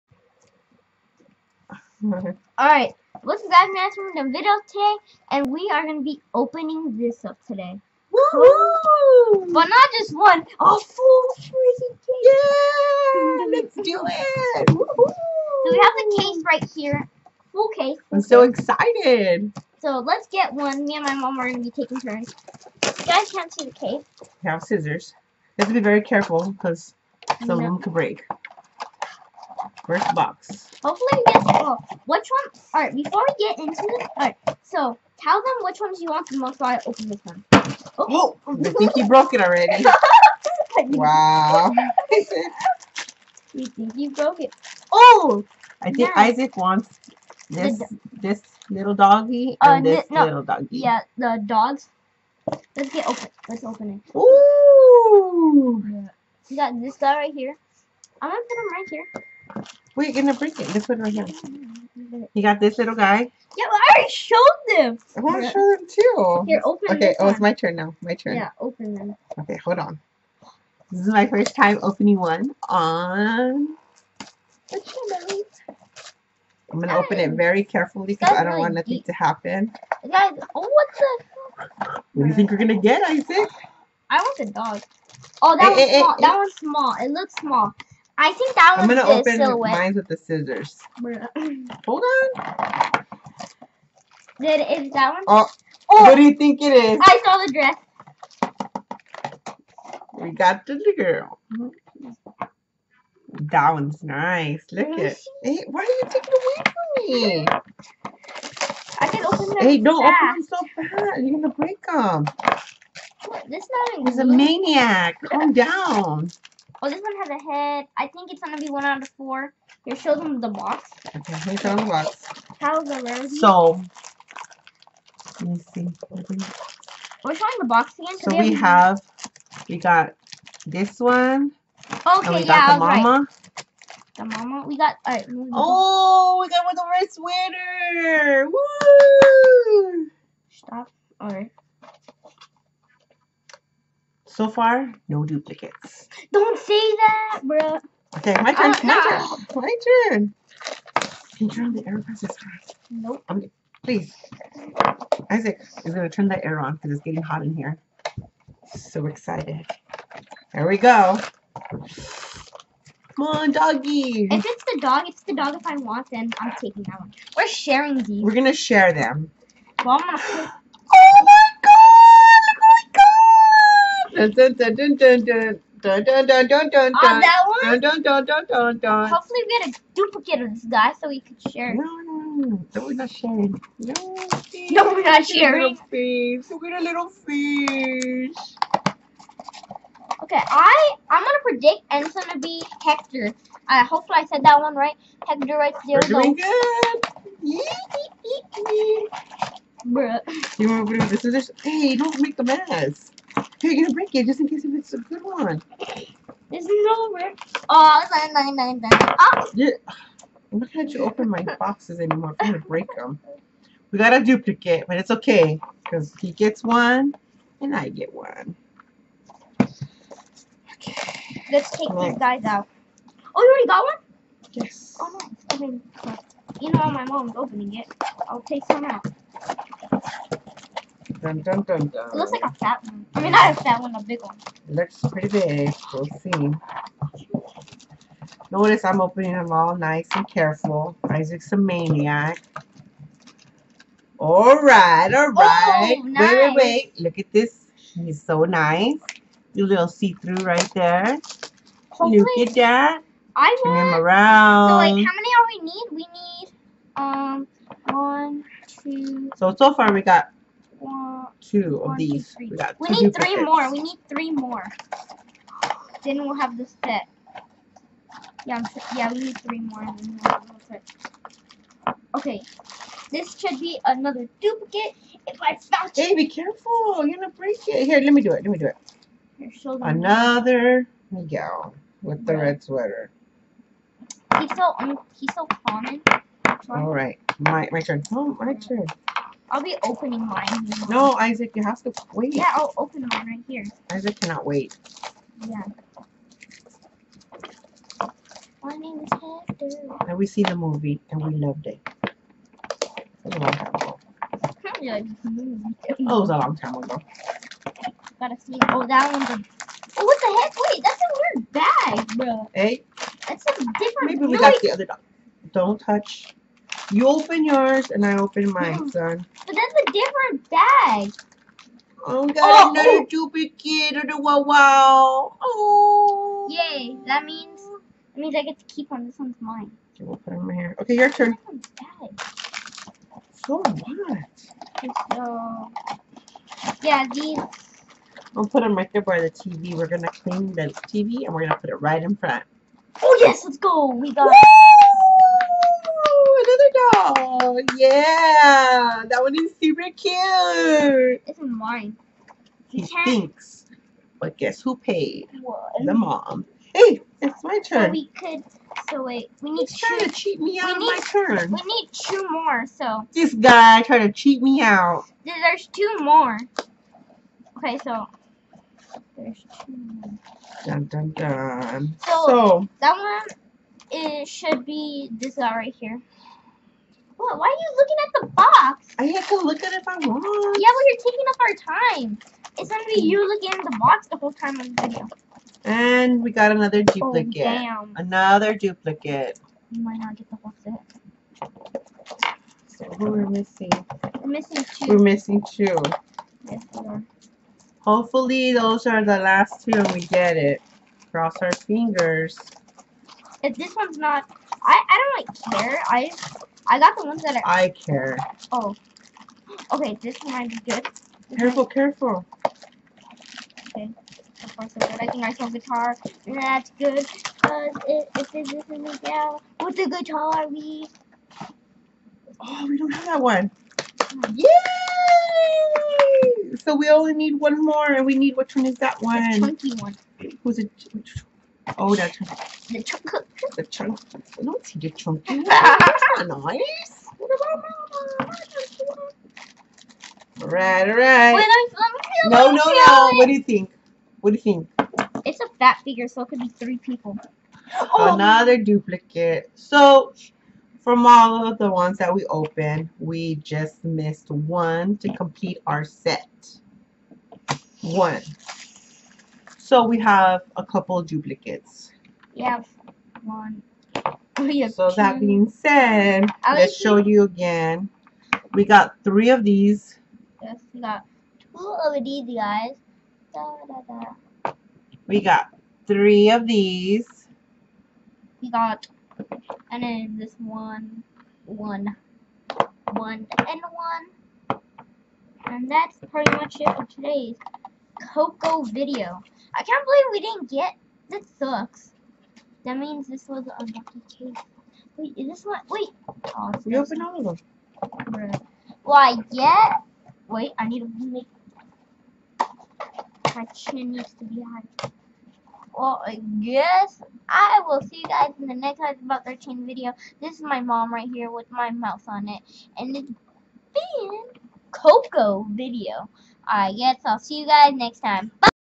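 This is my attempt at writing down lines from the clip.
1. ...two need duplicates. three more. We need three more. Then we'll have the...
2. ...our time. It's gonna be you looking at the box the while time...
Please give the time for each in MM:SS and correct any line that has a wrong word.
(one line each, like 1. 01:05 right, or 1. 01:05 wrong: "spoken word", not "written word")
1. 04:22 right
2. 06:21 wrong: "whole", not "while".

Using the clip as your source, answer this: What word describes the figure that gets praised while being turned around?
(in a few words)
See-through.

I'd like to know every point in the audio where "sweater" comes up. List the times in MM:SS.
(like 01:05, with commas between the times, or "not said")
02:18, 04:42.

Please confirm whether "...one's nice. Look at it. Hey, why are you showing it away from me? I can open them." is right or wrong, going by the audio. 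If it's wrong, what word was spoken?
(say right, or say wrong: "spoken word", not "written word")
wrong: "taking", not "showing".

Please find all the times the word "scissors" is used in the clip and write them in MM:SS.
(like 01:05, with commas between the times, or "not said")
00:24, 01:30, 03:21.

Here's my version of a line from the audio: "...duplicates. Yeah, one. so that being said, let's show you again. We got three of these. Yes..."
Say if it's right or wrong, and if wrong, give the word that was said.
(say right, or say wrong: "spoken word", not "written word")
right.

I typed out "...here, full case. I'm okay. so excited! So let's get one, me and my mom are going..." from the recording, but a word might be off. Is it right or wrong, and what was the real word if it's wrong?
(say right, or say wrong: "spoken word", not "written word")
right.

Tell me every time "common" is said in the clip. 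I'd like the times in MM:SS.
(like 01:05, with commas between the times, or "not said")
04:45.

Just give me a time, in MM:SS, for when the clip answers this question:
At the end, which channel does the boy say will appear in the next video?
08:28.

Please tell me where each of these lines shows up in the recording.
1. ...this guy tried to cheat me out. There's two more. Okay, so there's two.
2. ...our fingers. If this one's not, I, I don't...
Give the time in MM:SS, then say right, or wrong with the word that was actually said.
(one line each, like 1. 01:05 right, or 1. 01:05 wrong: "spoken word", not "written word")
1. 06:03 right
2. 06:41 right.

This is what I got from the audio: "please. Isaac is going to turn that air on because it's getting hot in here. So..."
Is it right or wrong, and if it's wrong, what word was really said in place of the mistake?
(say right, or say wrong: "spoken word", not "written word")
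right.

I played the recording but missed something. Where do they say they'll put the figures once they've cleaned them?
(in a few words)
By the TV.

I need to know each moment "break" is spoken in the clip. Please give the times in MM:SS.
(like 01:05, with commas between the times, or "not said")
00:27, 01:00, 01:51, 03:23, 03:32, 04:37.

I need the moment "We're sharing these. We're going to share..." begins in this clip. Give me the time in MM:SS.
02:47.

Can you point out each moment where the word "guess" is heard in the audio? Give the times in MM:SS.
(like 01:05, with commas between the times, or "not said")
05:54, 08:26, 08:36.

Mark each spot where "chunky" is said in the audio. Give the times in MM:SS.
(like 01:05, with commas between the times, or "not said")
07:09, 07:14.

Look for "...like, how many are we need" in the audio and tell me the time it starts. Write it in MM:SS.
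04:14.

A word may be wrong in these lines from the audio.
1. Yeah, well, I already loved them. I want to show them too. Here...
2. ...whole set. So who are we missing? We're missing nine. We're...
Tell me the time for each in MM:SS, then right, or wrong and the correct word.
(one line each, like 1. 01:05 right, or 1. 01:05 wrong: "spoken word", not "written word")
1. 01:03 wrong: "showed", not "loved"
2. 06:30 wrong: "two", not "nine".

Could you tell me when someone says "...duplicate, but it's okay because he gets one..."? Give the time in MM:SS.
03:34.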